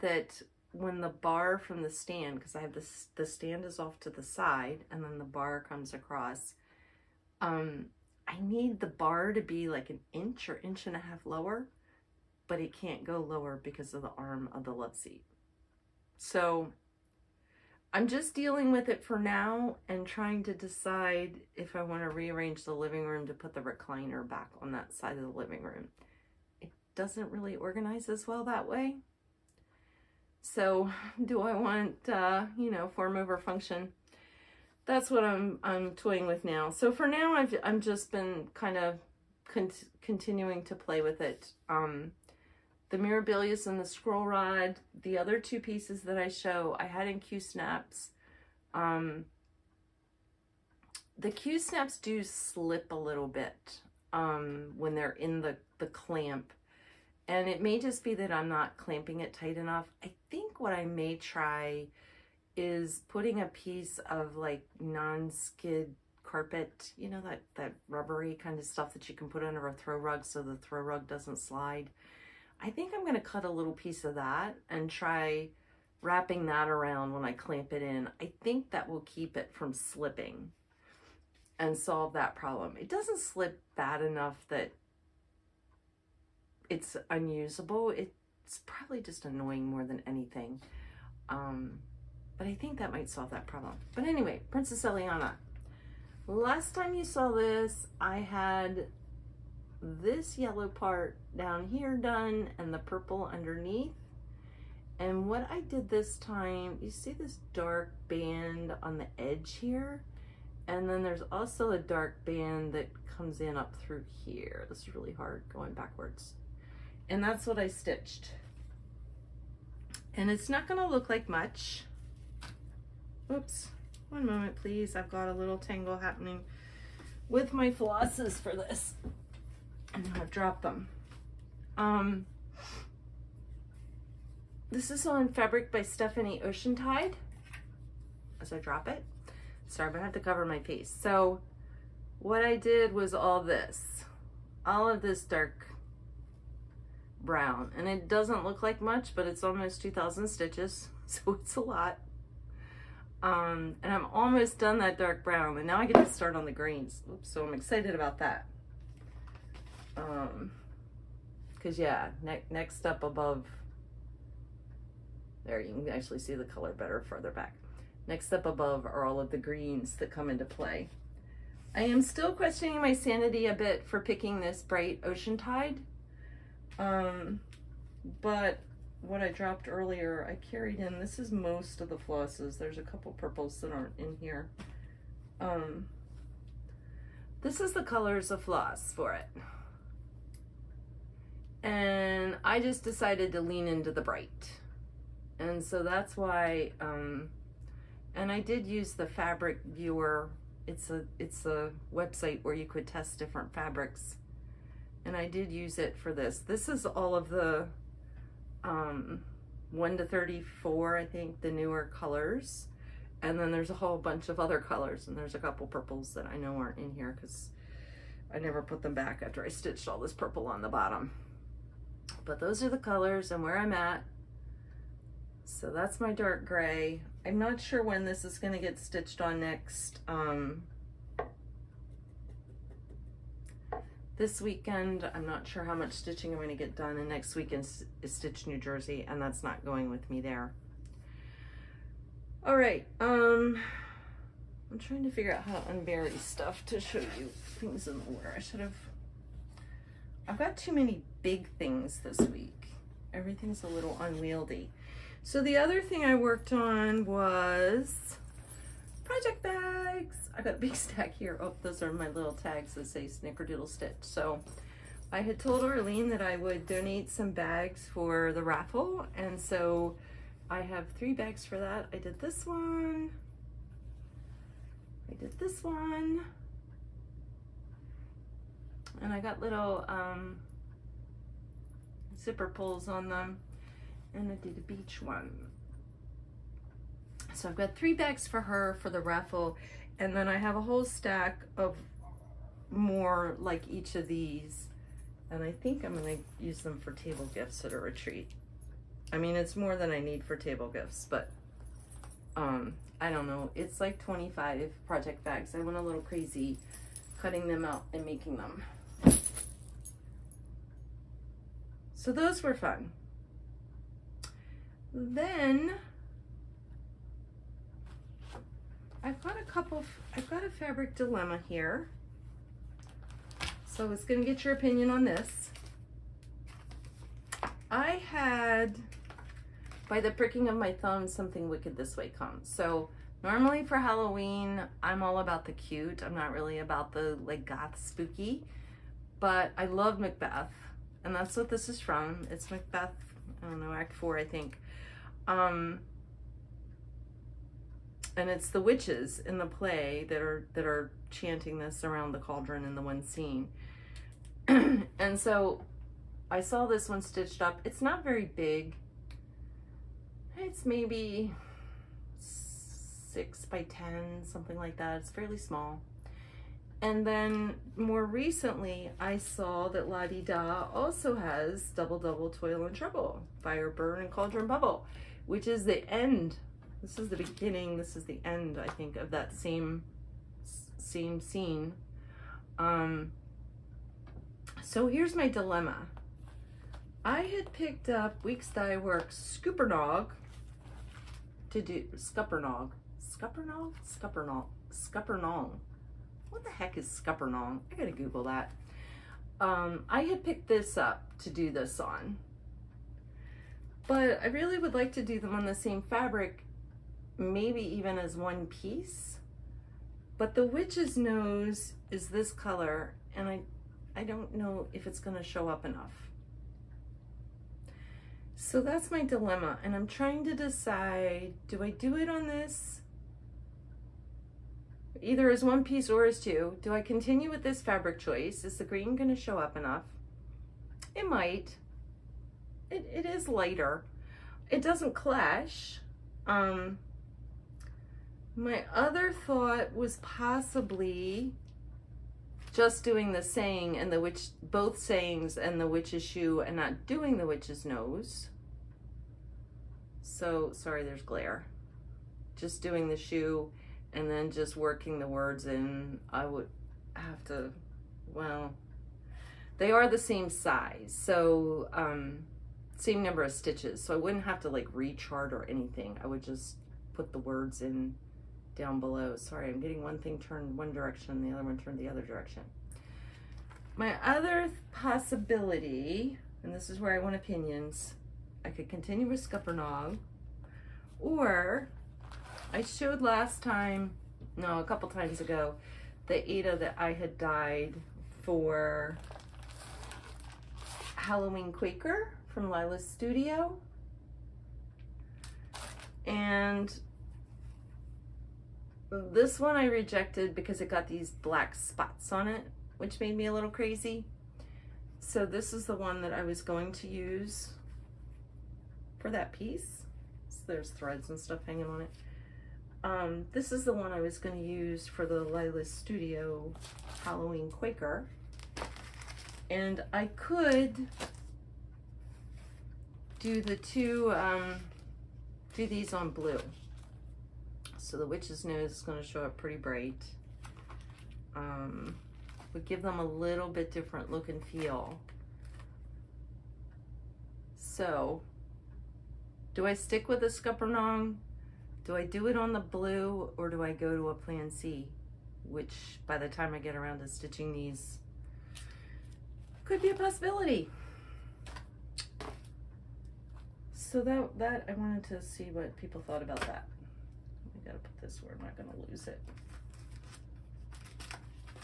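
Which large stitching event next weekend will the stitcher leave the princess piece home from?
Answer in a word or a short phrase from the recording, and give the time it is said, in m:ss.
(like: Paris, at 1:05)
Stitch New Jersey, at 3:58.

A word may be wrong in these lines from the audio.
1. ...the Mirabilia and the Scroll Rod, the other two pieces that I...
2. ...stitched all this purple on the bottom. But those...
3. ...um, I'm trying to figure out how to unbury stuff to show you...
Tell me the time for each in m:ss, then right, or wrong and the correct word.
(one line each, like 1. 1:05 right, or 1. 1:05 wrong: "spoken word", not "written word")
1. 0:42 right
2. 3:39 right
3. 4:03 right.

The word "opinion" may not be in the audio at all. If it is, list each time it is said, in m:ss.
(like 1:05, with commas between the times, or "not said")
5:24, 7:57.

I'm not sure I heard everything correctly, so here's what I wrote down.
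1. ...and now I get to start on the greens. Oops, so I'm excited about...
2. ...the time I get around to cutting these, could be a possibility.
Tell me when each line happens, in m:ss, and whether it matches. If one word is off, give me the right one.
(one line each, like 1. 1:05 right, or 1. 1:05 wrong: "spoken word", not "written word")
1. 2:35 right
2. 9:06 wrong: "stitching", not "cutting".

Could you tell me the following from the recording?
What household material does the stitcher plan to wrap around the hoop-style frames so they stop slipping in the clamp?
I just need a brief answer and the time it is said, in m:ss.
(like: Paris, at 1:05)
non-skid carpet, at 1:04.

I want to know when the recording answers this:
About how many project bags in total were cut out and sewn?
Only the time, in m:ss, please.
5:04.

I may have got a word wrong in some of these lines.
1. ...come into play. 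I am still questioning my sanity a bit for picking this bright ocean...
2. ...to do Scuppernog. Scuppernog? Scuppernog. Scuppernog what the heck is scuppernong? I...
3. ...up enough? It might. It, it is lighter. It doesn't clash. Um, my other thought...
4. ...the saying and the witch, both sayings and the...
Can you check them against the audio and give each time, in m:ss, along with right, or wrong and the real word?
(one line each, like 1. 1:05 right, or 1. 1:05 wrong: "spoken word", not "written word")
1. 2:50 right
2. 6:31 right
3. 7:09 right
4. 7:23 right.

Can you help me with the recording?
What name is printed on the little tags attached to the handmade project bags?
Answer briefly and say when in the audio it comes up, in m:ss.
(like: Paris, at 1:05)
Snickerdoodle Stitch, at 4:23.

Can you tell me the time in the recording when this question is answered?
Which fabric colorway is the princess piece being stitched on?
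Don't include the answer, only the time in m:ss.
2:16.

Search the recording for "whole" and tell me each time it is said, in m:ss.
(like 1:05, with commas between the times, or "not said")
3:33, 4:50.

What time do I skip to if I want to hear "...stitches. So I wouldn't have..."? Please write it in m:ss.
7:43.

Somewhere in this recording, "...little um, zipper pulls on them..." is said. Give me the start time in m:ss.
4:39.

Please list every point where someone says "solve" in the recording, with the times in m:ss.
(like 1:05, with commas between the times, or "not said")
1:21, 1:33.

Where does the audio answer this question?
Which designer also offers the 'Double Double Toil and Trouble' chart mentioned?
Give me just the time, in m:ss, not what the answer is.
6:09.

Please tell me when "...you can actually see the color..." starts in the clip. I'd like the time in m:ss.
2:45.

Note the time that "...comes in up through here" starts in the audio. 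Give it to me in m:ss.
1:53.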